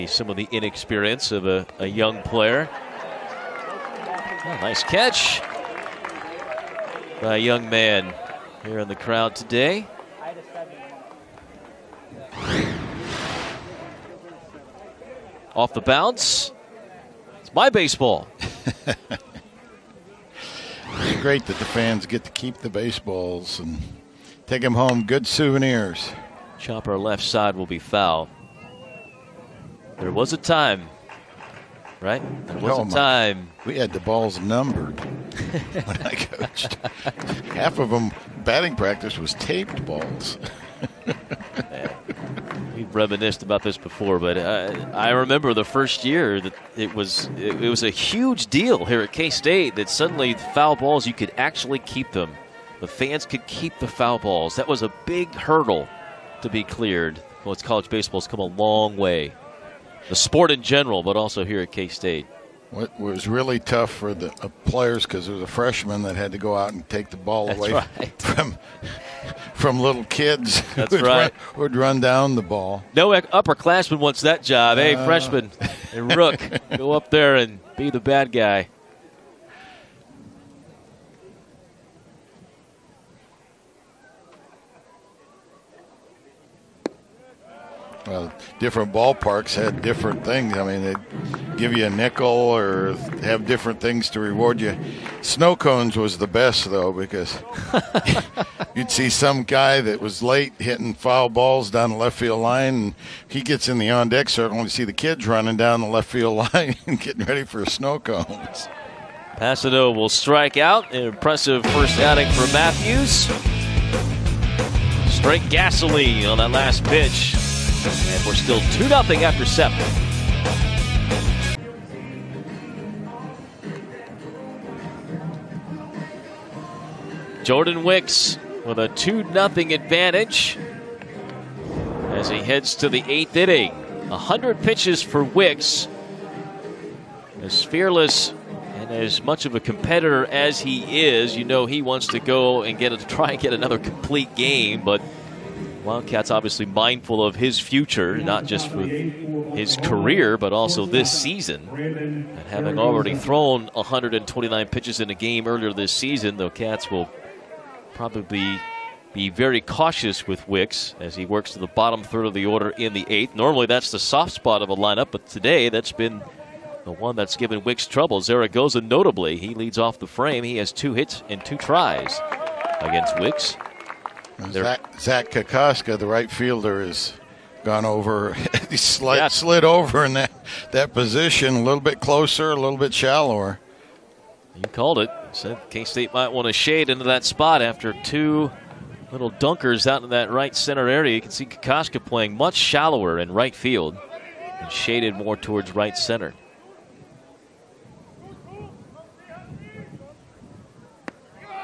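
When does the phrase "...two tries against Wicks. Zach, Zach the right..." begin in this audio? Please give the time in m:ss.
2:51.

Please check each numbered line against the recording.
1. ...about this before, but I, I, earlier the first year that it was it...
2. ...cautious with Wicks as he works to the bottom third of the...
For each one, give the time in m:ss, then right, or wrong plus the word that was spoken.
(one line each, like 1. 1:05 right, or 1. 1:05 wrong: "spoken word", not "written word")
1. 0:43 wrong: "remember", not "earlier"
2. 2:39 right.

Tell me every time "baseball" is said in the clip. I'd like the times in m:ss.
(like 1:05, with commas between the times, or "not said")
0:17, 0:22, 0:57.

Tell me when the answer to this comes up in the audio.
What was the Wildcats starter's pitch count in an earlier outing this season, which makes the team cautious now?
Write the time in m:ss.
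2:33.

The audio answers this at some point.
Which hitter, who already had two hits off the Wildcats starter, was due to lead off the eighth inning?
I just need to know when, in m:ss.
2:48.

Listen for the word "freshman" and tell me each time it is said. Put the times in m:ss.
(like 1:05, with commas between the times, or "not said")
1:05, 1:15.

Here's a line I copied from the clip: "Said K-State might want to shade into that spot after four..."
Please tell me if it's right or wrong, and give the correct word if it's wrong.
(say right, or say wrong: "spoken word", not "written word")
wrong: "two", not "four".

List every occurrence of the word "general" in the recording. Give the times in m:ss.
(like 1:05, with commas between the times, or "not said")
1:00.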